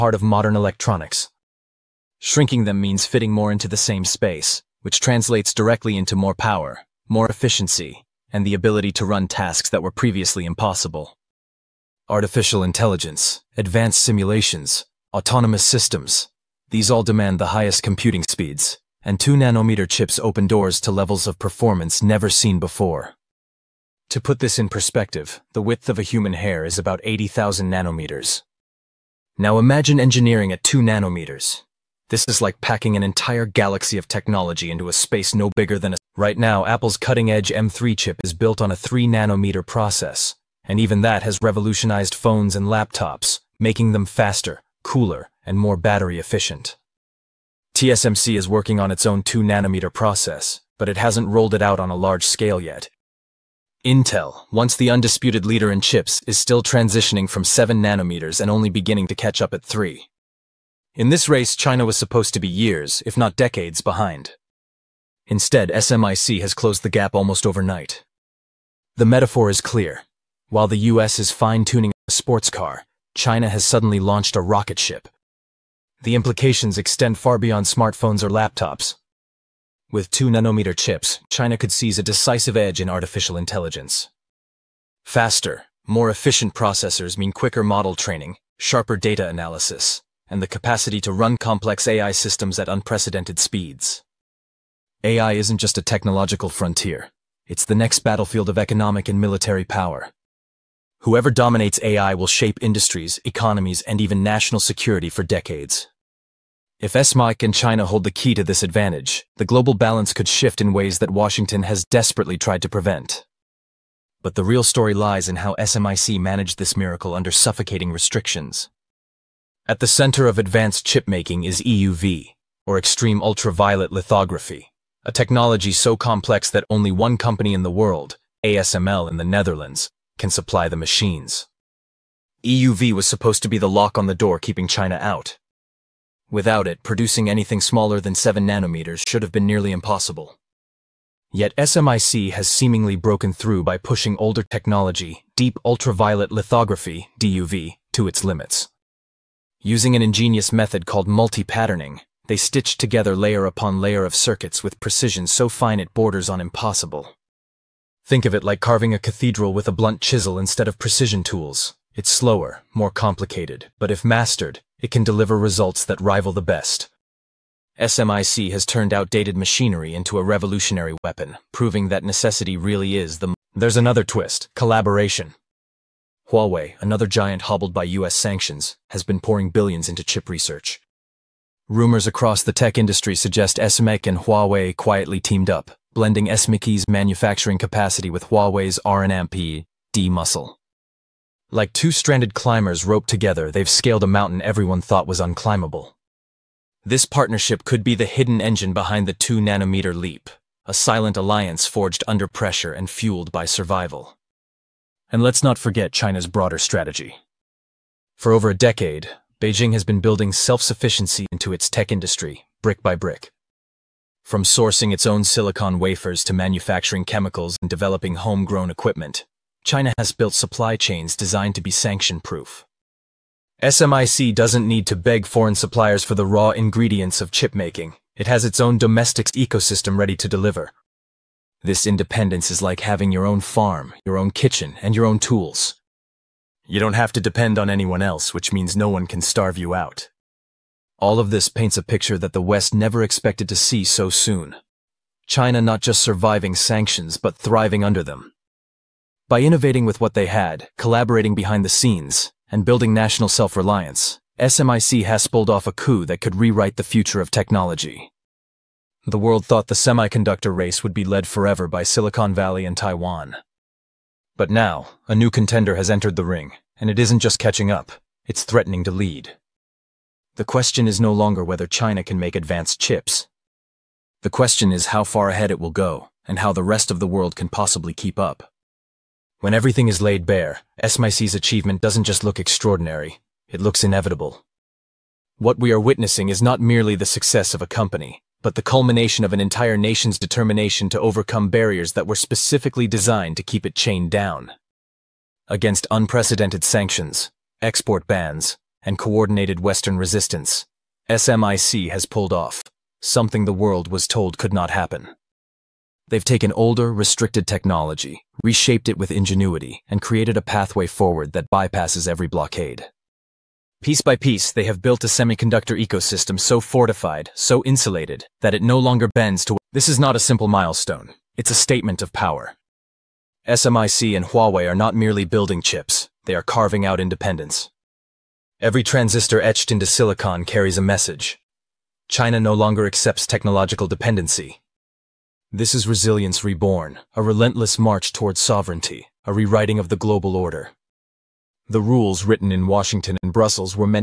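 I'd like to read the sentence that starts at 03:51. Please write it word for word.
This independence is like having your own farm, your own kitchen, and your own tools.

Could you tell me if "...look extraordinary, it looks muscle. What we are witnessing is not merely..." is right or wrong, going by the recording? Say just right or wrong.
wrong.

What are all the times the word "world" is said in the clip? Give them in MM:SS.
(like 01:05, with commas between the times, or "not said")
02:07, 04:19, 04:37, 05:03.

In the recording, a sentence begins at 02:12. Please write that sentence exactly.
EUV was supposed to be the lock on the door keeping China out.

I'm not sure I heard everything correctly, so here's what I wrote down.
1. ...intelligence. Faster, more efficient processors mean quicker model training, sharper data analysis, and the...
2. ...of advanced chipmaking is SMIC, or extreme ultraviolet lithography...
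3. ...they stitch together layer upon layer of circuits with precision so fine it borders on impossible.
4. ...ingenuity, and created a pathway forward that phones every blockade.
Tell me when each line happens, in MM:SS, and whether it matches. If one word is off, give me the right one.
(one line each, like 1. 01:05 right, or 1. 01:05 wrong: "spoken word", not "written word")
1. 01:23 right
2. 02:00 wrong: "EUV", not "SMIC"
3. 02:32 right
4. 05:09 wrong: "bypasses", not "phones".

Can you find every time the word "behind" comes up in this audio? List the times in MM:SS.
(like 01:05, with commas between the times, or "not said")
01:03, 03:18, 04:11.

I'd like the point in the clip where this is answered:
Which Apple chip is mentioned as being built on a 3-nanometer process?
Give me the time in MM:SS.
00:37.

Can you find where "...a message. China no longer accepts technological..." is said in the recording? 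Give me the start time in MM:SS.
05:30.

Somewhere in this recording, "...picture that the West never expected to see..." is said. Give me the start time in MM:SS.
04:01.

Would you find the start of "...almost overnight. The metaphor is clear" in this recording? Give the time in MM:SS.
01:07.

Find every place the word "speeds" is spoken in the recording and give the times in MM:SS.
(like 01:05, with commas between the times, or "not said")
00:18, 01:33.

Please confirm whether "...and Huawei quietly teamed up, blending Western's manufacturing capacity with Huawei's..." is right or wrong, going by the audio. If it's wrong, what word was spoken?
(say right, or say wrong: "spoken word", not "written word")
wrong: "SMIC", not "Western".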